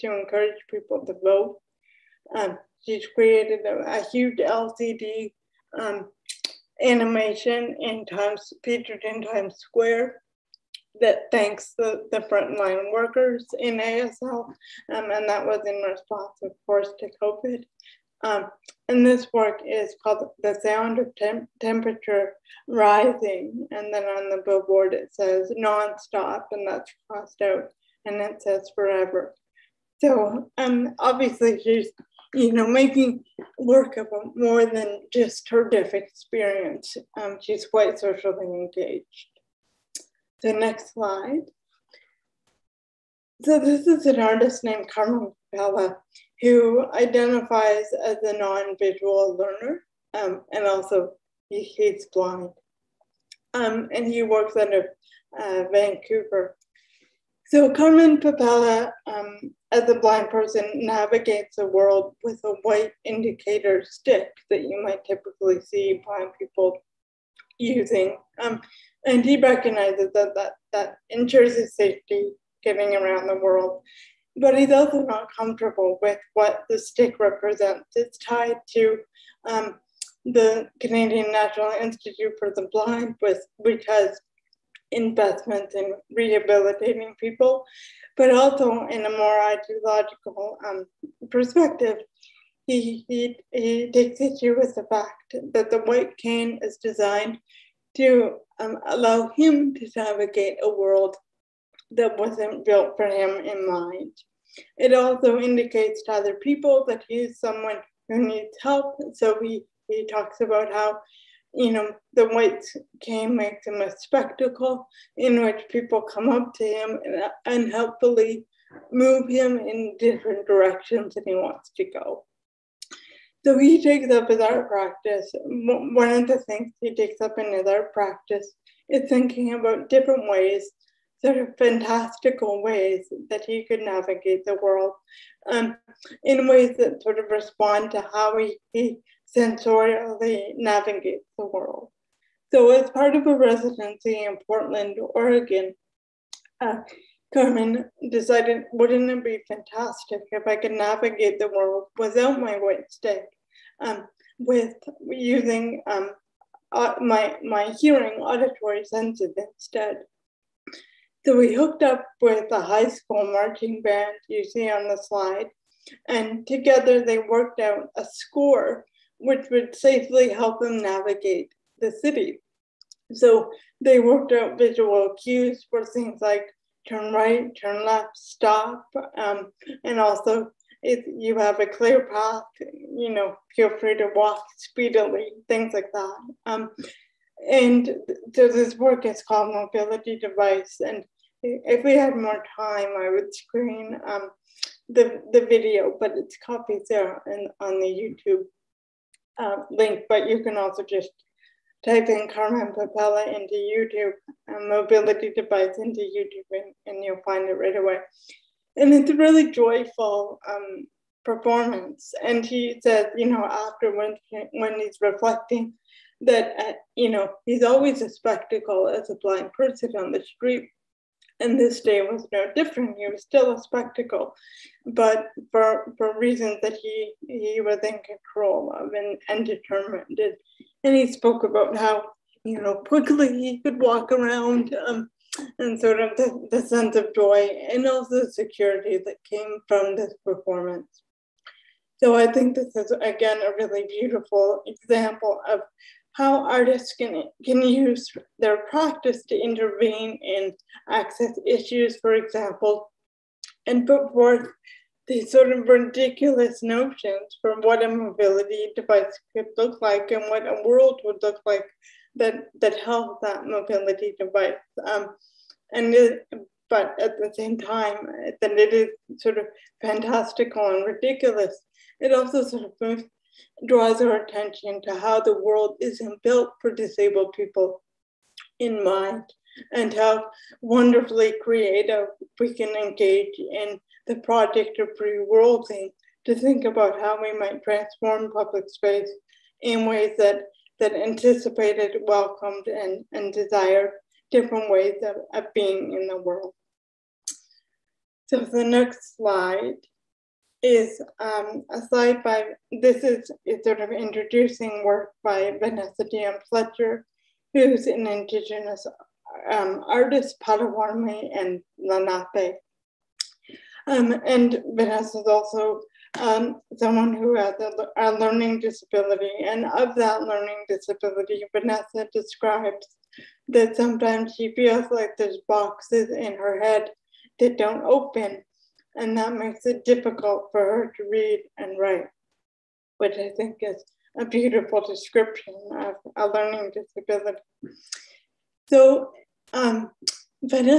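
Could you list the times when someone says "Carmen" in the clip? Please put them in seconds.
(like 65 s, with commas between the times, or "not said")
44 s, 57 s, 147 s, 202 s.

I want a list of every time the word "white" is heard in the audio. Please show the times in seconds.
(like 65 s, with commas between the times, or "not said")
62 s, 95 s, 112 s, 152 s.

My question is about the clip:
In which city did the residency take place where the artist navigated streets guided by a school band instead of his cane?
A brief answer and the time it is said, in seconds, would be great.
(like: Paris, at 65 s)
Portland, Oregon, at 144 s.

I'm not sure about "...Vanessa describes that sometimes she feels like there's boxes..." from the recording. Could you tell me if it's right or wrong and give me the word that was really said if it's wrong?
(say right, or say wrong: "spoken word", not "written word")
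right.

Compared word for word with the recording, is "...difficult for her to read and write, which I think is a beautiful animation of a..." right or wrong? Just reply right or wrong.
wrong.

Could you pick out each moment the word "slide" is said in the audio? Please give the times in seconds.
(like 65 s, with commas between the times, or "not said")
40 s, 164 s, 299 s.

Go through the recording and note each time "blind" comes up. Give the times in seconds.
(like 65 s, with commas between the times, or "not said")
52 s, 59 s, 66 s, 82 s, 219 s.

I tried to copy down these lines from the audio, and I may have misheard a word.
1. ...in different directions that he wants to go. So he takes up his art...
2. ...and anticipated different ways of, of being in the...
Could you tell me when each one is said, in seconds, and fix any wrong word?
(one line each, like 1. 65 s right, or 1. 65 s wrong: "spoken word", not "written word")
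1. 119 s right
2. 293 s wrong: "desired", not "anticipated".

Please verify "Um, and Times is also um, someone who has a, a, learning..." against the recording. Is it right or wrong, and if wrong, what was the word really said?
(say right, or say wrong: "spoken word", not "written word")
wrong: "Vanessa", not "Times".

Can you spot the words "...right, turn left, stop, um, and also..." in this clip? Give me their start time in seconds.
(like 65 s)
177 s.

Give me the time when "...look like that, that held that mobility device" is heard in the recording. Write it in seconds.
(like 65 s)
261 s.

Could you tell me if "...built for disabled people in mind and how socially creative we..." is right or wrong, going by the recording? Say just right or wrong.
wrong.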